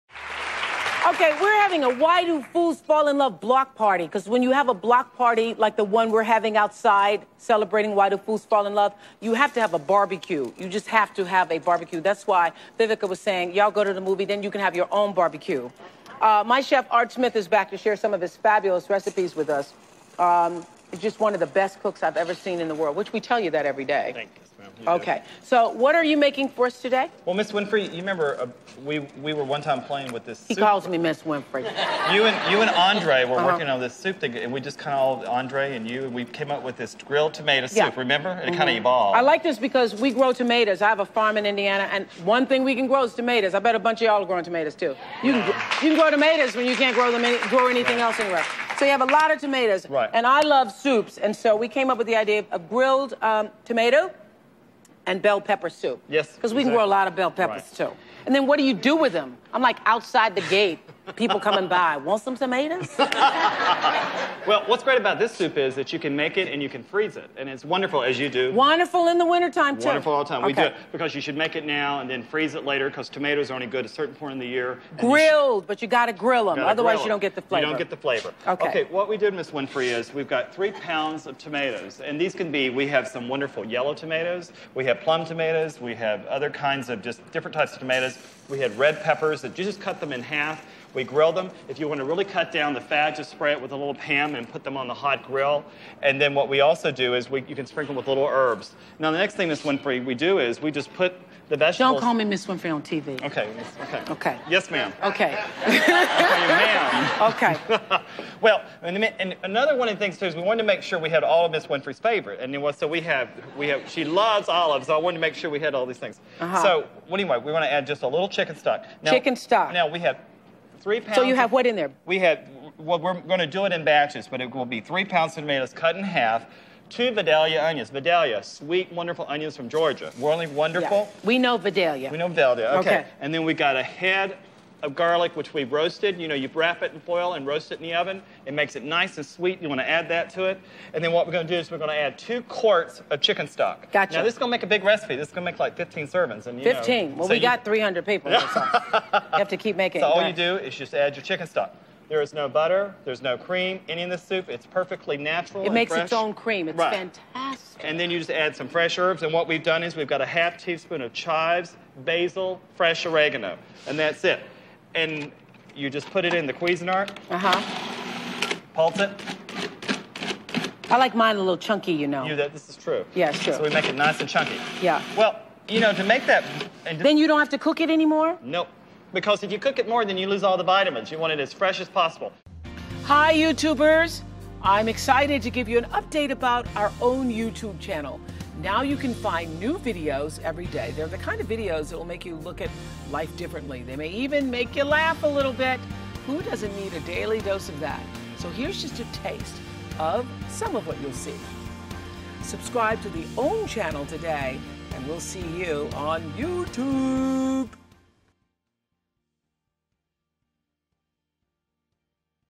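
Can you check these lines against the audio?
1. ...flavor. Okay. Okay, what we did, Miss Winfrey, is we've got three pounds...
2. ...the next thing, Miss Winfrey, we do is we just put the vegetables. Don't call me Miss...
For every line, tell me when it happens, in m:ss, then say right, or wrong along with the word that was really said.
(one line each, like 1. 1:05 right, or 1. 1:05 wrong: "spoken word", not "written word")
1. 1:17 right
2. 1:39 right.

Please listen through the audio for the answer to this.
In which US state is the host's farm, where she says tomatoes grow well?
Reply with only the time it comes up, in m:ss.
0:41.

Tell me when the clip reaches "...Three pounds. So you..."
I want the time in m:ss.
2:00.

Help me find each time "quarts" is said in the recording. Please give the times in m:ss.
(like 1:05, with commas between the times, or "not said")
2:22.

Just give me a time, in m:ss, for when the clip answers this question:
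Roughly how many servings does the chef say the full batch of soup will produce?
2:25.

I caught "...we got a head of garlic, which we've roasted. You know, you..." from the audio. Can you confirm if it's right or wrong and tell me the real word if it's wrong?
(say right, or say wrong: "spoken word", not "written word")
right.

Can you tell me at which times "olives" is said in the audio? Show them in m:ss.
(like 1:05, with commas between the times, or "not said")
1:54.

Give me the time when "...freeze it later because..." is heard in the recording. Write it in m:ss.
1:12.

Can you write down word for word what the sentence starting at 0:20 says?
Um, just one of the best cooks I've ever seen in the world, which we tell you that every day okay.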